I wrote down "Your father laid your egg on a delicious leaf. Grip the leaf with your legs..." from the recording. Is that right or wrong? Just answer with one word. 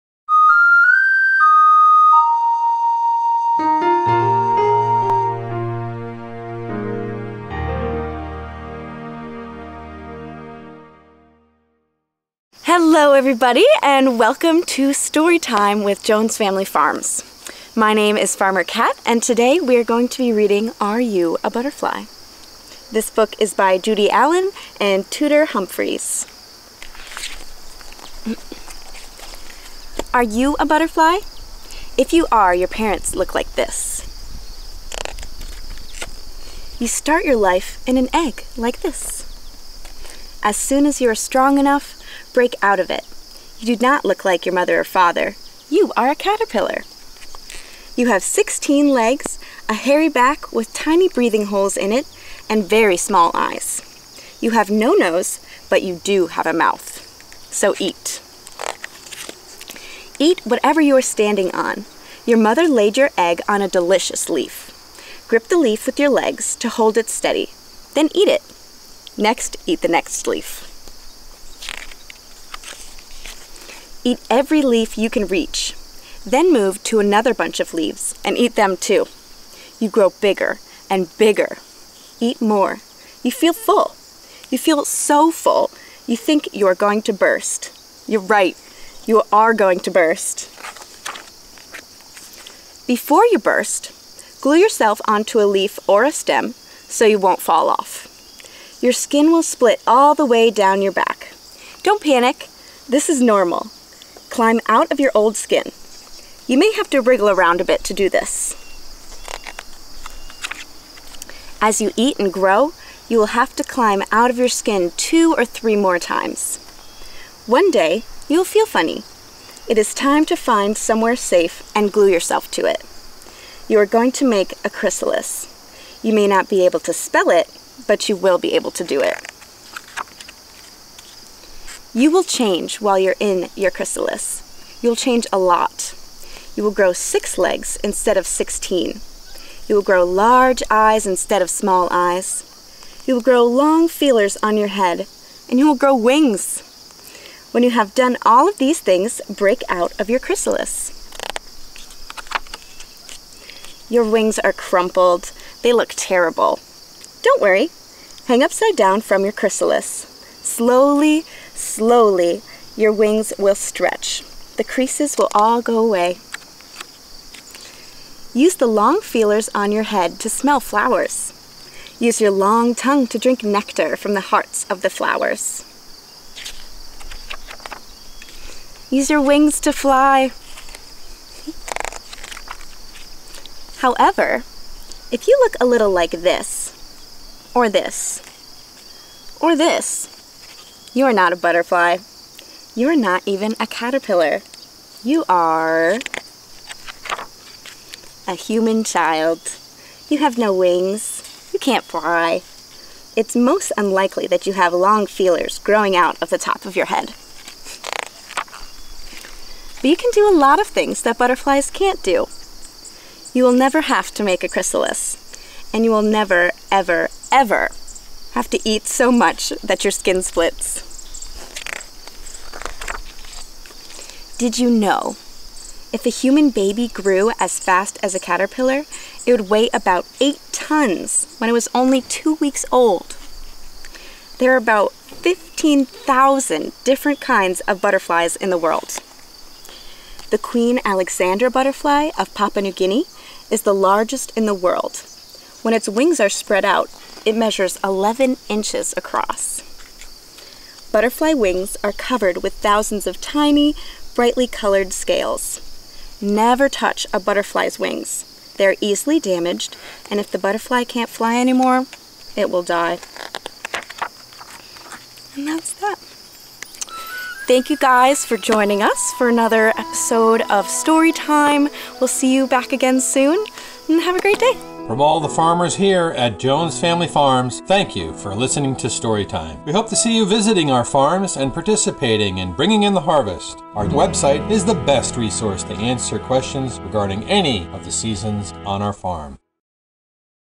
wrong.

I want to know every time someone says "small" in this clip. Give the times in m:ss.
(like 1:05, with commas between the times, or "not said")
0:52, 2:21.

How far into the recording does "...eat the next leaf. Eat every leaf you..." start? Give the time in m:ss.
1:09.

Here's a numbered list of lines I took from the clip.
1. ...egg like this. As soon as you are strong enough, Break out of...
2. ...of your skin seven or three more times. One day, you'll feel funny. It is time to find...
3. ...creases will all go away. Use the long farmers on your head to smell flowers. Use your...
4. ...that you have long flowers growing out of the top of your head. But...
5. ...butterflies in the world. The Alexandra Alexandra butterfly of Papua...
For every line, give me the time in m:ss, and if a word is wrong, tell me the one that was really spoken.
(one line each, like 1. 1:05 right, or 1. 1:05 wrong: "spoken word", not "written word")
1. 0:38 right
2. 1:54 wrong: "two", not "seven"
3. 2:44 wrong: "feelers", not "farmers"
4. 3:24 wrong: "feelers", not "flowers"
5. 3:57 wrong: "Queen", not "Alexandra".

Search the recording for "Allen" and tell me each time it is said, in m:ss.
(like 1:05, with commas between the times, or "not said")
0:24.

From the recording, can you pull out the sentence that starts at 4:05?
When its wings are spread out, it measures 11 inches across.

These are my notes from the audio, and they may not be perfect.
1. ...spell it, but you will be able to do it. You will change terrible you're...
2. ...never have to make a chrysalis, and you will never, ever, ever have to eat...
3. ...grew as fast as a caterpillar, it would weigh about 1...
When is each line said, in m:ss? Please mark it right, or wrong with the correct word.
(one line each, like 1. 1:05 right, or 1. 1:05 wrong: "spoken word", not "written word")
1. 2:06 wrong: "while", not "terrible"
2. 3:33 right
3. 3:46 wrong: "8", not "1".